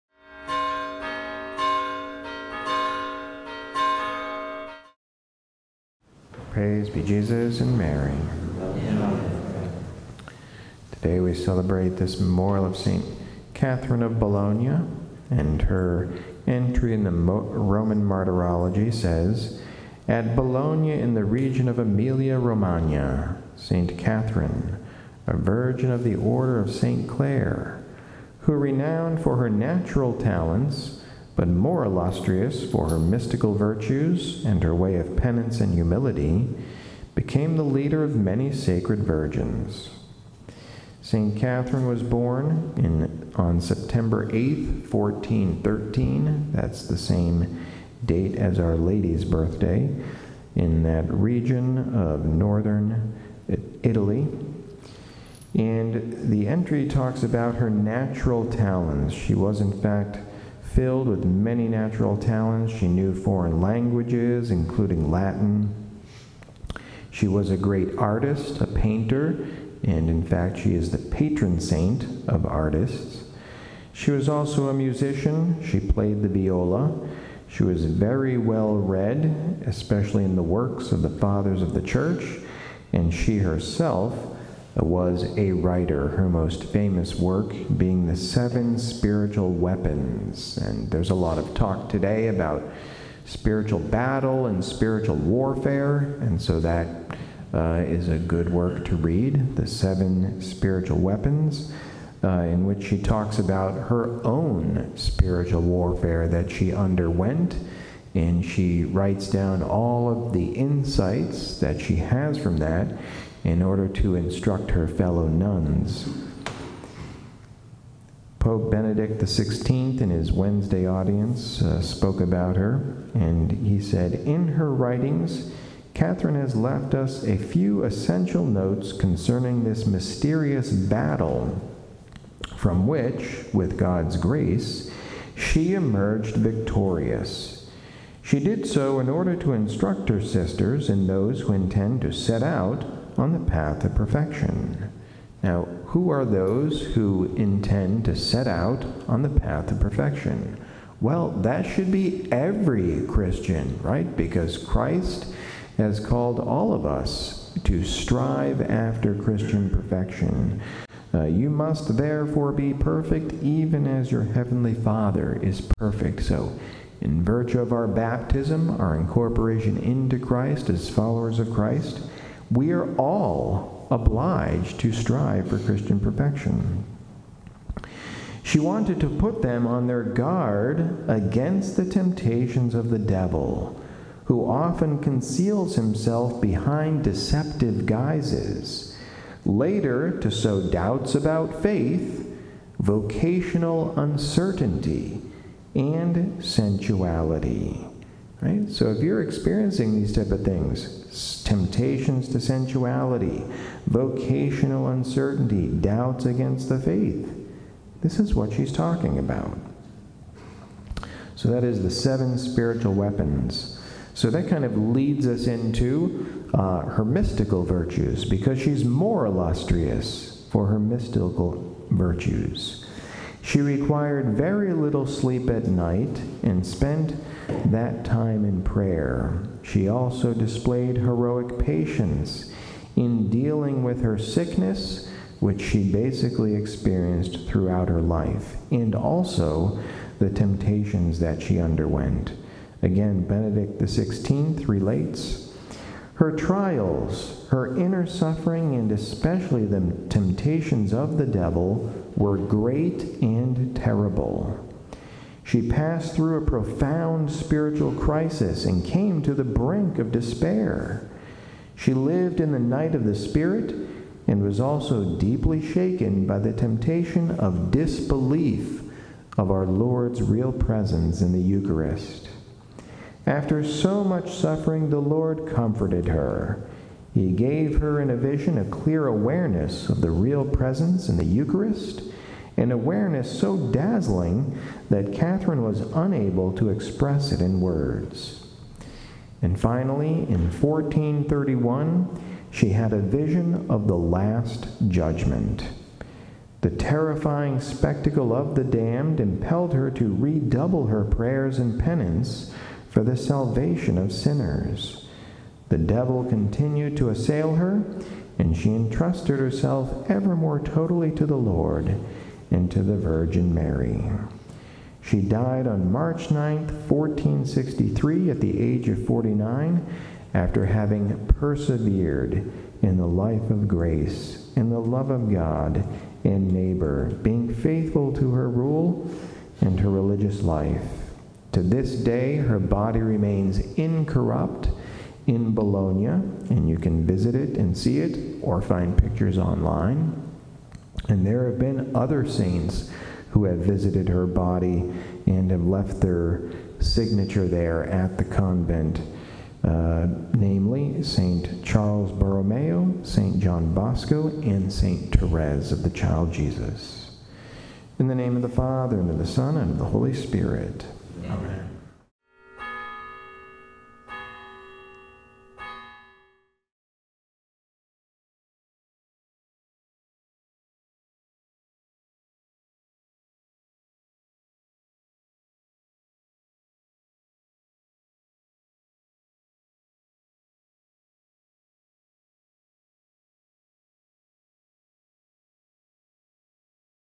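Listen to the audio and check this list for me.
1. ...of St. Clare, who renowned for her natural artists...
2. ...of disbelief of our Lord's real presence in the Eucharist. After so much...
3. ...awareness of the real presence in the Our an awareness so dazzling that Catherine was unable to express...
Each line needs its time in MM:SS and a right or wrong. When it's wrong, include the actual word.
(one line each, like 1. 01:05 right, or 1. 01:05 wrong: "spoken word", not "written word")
1. 00:26 wrong: "talents", not "artists"
2. 04:27 right
3. 04:39 wrong: "Eucharist", not "Our".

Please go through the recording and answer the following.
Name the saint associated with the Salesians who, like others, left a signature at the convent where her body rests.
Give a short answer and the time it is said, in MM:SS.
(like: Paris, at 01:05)
St. John Bosco, at 05:53.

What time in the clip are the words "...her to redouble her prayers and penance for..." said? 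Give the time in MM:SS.
04:59.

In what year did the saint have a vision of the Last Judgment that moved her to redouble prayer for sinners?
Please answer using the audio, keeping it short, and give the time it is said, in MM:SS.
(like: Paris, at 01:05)
1431, at 04:50.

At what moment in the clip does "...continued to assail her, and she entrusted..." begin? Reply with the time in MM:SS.
05:06.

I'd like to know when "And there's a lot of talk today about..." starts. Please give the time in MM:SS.
01:30.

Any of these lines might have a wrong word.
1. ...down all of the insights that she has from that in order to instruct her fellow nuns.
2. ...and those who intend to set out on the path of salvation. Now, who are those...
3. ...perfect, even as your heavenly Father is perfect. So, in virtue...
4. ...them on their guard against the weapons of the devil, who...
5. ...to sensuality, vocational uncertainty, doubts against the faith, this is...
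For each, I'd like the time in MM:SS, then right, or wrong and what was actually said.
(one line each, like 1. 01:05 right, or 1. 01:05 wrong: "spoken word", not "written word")
1. 01:49 right
2. 02:20 wrong: "perfection", not "salvation"
3. 02:42 right
4. 02:59 wrong: "temptations", not "weapons"
5. 03:22 right.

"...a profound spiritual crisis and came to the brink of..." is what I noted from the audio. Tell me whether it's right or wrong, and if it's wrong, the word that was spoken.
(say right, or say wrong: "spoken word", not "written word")
right.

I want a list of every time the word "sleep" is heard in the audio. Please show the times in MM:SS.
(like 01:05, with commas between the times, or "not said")
03:45.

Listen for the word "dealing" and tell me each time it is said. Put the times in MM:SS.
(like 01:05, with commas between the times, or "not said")
03:53.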